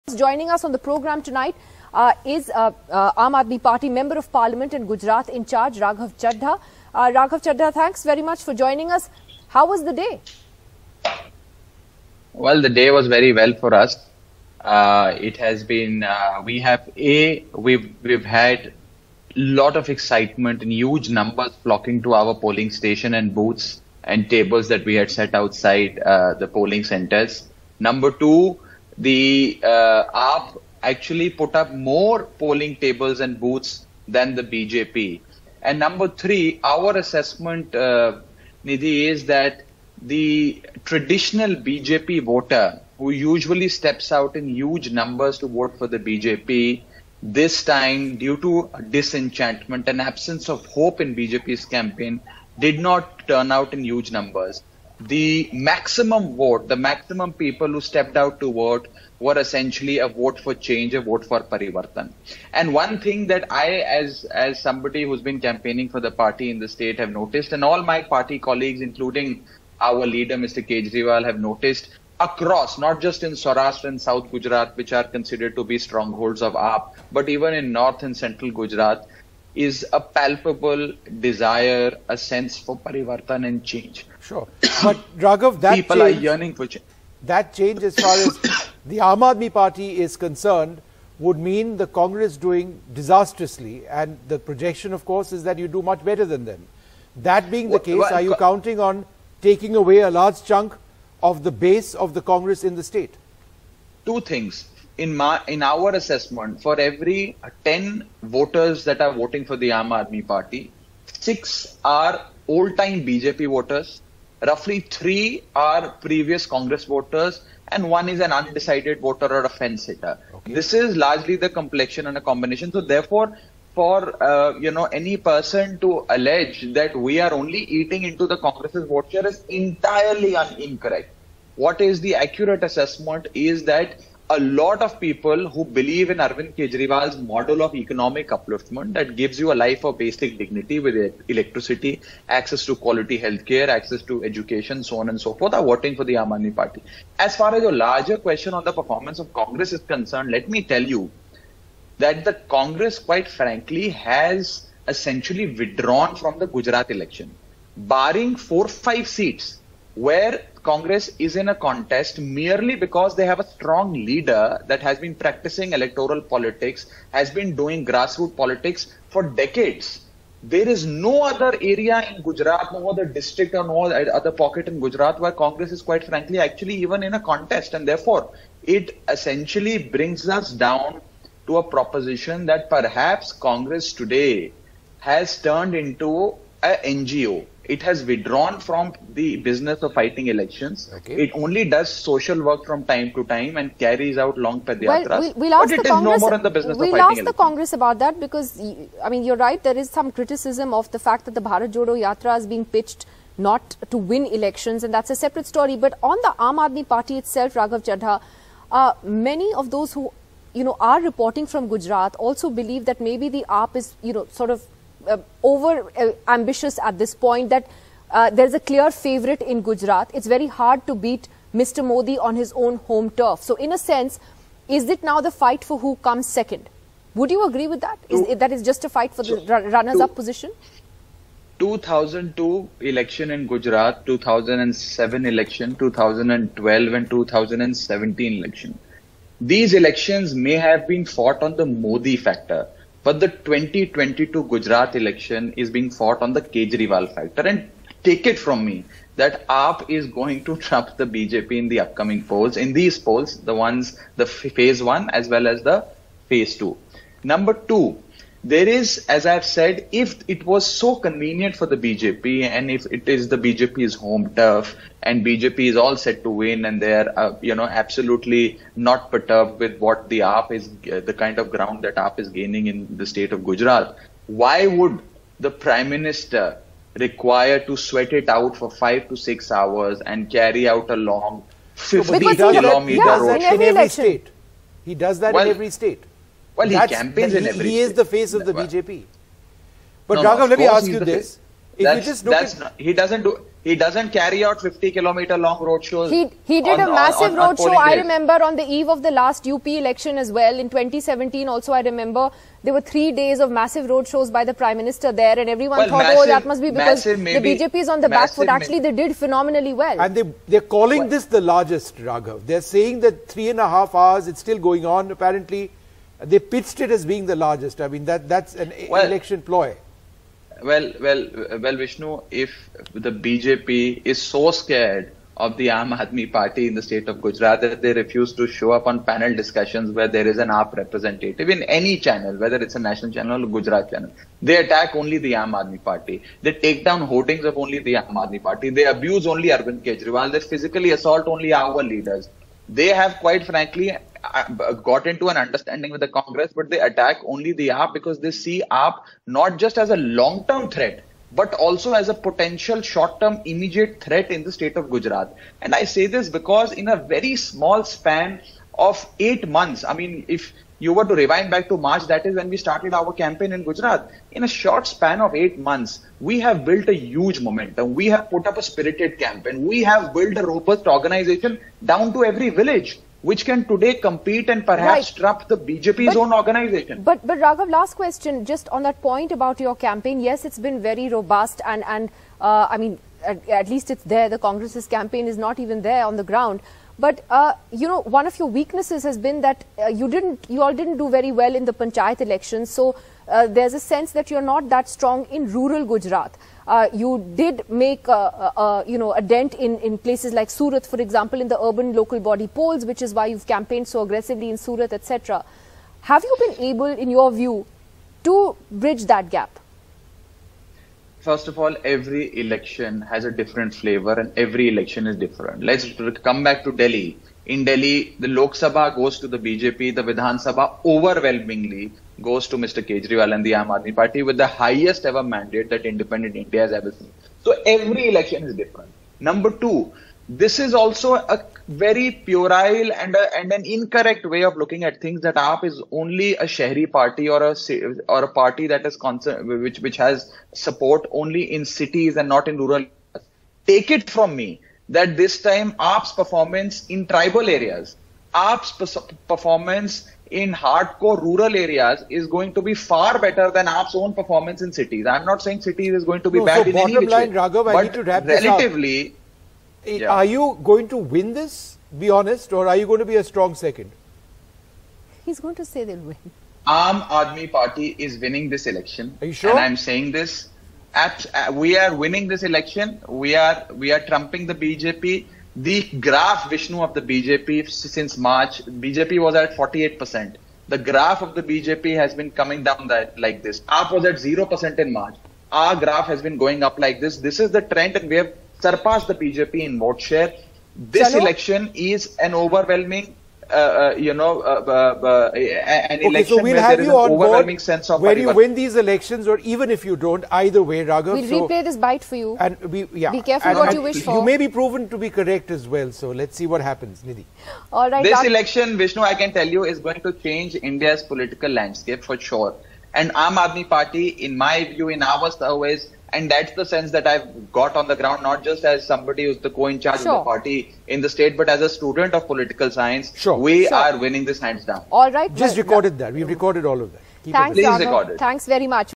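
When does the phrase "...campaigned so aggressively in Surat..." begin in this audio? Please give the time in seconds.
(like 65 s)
403 s.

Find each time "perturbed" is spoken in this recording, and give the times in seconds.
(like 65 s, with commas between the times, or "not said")
269 s.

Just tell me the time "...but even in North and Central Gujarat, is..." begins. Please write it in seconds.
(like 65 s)
77 s.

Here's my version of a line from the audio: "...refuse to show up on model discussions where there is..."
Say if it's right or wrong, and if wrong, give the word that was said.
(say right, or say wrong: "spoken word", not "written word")
wrong: "panel", not "model".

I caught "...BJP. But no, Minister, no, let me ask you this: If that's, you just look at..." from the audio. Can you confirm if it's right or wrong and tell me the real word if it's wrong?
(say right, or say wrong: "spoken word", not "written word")
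wrong: "Raghav", not "Minister".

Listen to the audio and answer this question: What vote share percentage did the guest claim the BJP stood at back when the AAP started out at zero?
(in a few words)
48%.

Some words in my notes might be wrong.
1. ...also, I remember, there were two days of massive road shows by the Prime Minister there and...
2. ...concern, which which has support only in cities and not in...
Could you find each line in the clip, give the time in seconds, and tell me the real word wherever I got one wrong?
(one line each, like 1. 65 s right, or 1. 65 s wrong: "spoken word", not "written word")
1. 301 s wrong: "three", not "two"
2. 438 s right.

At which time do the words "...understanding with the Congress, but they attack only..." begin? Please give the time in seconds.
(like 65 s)
345 s.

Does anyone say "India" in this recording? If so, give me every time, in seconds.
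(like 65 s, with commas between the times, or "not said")
426 s, 510 s.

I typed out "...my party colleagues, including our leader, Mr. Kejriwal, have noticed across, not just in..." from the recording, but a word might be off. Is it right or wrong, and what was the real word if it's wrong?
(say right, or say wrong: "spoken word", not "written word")
right.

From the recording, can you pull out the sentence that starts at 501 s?
We'll so, replay this bite for you.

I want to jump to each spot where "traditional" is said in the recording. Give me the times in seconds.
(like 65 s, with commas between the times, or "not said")
40 s.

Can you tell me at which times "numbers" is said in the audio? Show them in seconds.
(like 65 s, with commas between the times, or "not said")
21 s, 27 s, 35 s, 44 s, 54 s, 257 s, 429 s.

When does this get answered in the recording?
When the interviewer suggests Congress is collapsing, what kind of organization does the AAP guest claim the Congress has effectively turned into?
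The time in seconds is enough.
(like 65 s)
186 s.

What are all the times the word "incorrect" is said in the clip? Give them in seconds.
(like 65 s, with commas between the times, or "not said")
130 s, 433 s.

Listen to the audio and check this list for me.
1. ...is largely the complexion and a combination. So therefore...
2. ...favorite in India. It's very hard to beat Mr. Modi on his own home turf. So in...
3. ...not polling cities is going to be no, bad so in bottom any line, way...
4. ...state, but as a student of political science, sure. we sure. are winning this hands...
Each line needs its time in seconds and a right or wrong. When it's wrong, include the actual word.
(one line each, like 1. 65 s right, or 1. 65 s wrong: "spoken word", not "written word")
1. 120 s right
2. 218 s wrong: "Gujarat", not "India"
3. 455 s wrong: "saying", not "polling"
4. 521 s right.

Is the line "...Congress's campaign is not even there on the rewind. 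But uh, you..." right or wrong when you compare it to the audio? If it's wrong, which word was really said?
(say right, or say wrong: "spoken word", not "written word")
wrong: "ground", not "rewind".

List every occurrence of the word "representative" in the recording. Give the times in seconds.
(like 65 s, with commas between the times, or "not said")
330 s.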